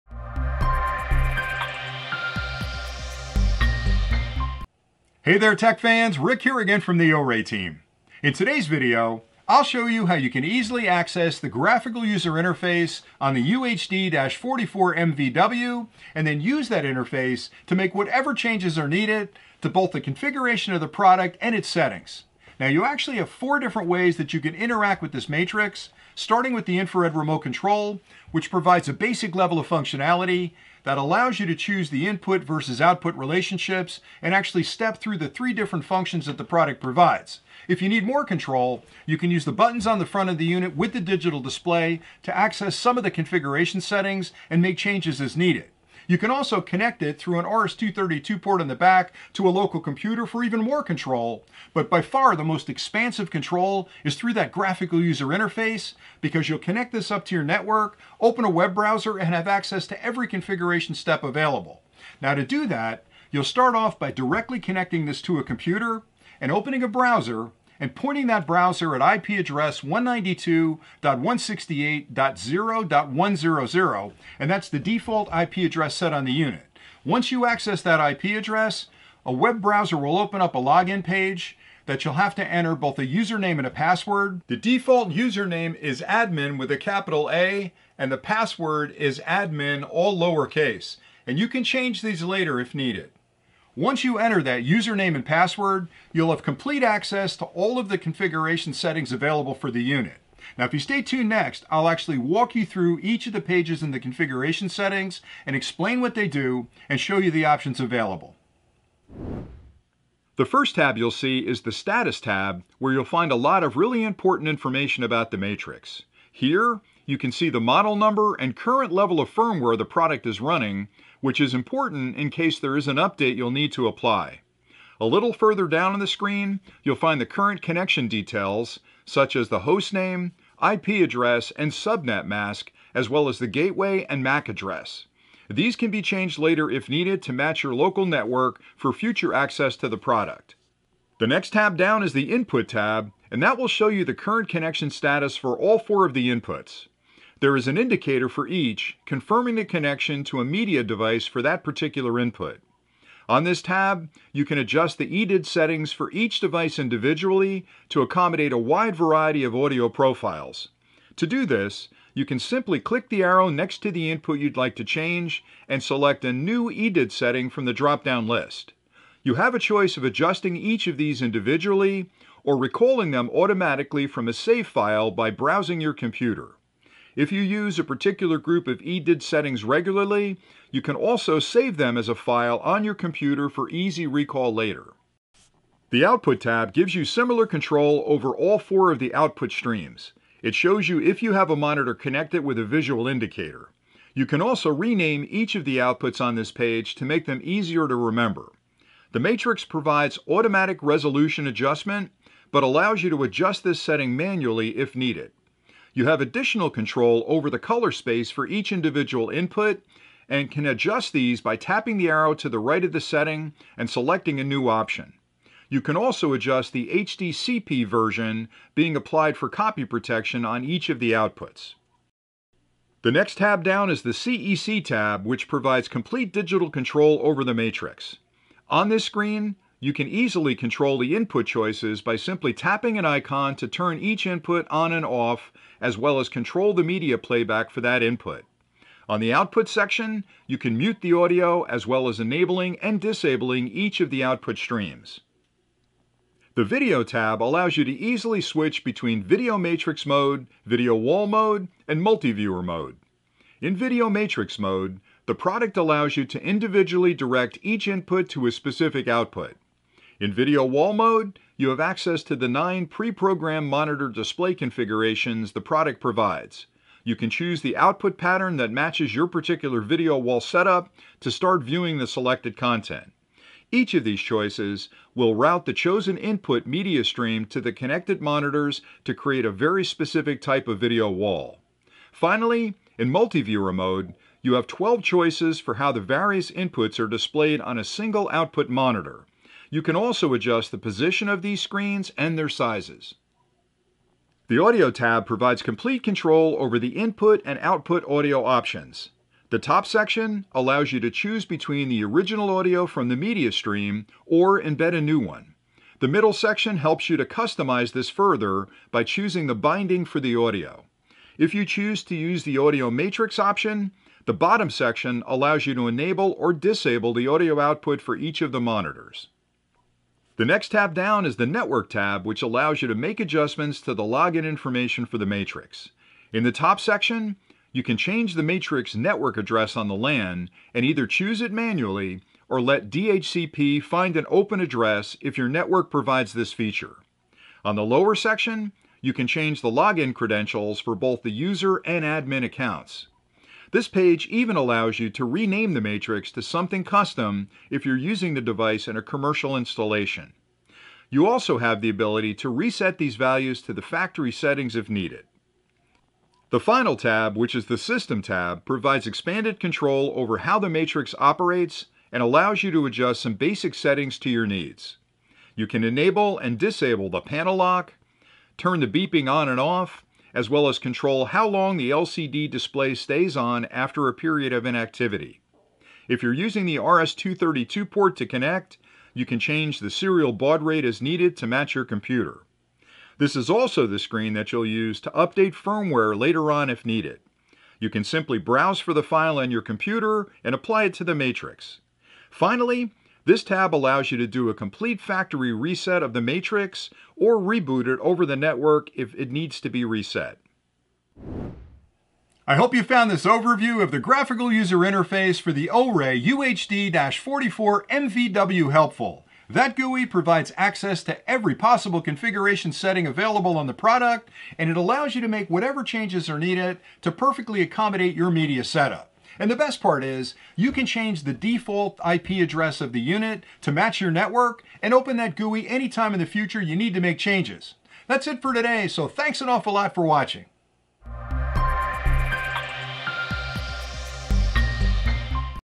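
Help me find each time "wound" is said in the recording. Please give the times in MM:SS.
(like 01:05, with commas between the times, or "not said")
not said.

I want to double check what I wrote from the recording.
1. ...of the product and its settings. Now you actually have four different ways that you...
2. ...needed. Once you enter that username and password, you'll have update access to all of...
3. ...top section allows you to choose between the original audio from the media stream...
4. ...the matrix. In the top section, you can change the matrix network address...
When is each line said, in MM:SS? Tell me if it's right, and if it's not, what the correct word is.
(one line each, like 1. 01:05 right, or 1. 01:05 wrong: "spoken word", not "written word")
1. 00:20 right
2. 01:32 wrong: "complete", not "update"
3. 04:59 right
4. 05:25 right.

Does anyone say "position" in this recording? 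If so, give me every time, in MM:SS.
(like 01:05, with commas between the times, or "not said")
04:50.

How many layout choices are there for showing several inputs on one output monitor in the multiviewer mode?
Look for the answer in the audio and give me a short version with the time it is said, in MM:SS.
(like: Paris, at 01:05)
12, at 04:44.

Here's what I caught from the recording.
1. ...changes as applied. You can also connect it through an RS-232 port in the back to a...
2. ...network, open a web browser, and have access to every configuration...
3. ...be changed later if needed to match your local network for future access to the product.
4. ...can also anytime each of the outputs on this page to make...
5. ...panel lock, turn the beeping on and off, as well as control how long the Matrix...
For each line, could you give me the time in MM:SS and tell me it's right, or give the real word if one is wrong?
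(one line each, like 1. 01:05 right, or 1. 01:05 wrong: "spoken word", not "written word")
1. 00:44 wrong: "needed", not "applied"
2. 00:57 right
3. 02:15 right
4. 03:14 wrong: "rename", not "anytime"
5. 06:07 wrong: "LCD", not "Matrix".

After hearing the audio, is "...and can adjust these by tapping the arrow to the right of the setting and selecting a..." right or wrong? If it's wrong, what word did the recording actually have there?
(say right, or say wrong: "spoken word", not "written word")
right.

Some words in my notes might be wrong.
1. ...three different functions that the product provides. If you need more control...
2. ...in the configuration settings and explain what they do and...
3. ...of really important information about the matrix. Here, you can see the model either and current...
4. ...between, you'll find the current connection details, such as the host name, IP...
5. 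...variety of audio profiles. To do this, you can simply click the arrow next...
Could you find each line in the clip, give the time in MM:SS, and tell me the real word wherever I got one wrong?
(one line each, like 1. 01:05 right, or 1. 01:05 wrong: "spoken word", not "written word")
1. 00:35 right
2. 01:43 right
3. 01:53 wrong: "number", not "either"
4. 02:06 wrong: "screen", not "between"
5. 02:38 right.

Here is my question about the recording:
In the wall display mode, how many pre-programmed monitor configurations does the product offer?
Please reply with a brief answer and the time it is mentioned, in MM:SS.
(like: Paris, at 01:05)
9, at 04:22.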